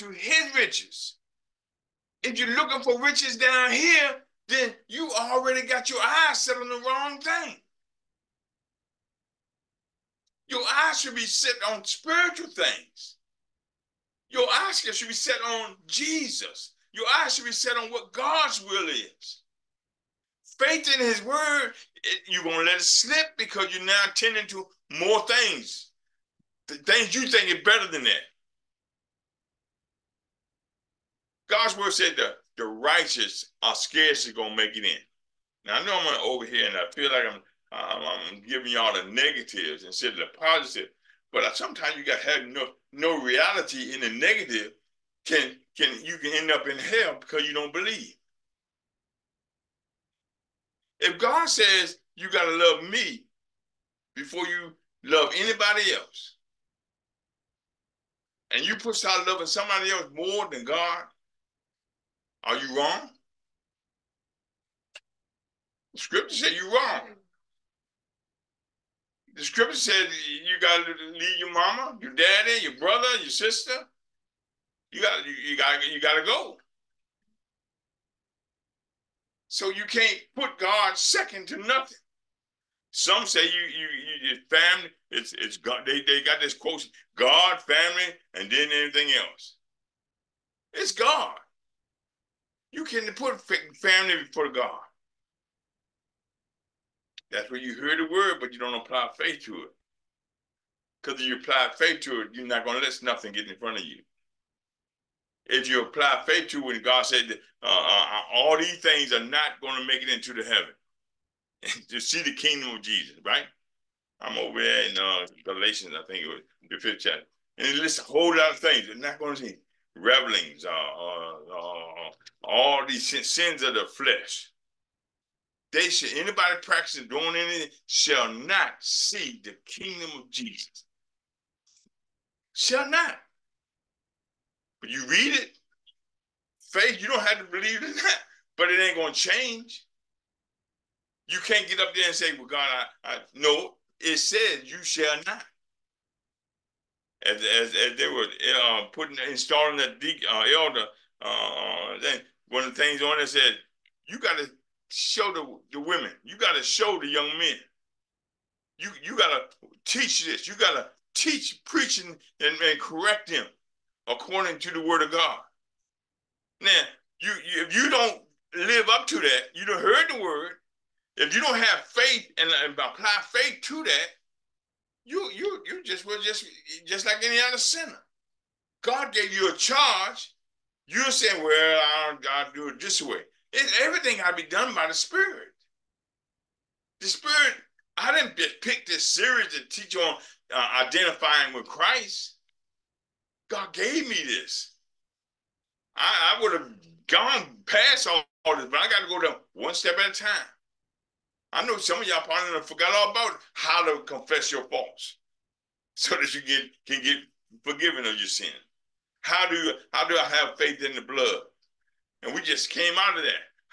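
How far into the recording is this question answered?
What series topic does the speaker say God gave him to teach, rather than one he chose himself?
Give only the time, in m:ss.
3:10.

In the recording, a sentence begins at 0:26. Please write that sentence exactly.
The things you think are better than that.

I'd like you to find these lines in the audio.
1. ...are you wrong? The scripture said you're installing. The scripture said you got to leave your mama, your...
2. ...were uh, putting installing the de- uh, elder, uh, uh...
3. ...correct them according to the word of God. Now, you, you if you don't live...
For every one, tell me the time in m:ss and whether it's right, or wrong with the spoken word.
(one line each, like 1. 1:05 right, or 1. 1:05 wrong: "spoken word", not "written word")
1. 1:02 wrong: "wrong", not "installing"
2. 2:28 right
3. 2:42 right.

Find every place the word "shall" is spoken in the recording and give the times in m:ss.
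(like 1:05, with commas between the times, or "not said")
2:07, 2:12, 2:24.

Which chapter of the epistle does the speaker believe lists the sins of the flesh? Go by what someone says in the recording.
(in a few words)
5th.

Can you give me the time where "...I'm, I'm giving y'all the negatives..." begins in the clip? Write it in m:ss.
0:37.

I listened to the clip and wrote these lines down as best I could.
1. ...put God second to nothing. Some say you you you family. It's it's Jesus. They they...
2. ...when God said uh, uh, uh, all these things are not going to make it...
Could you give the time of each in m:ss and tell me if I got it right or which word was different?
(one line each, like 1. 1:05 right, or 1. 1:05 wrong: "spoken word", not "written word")
1. 1:20 wrong: "God", not "Jesus"
2. 1:46 right.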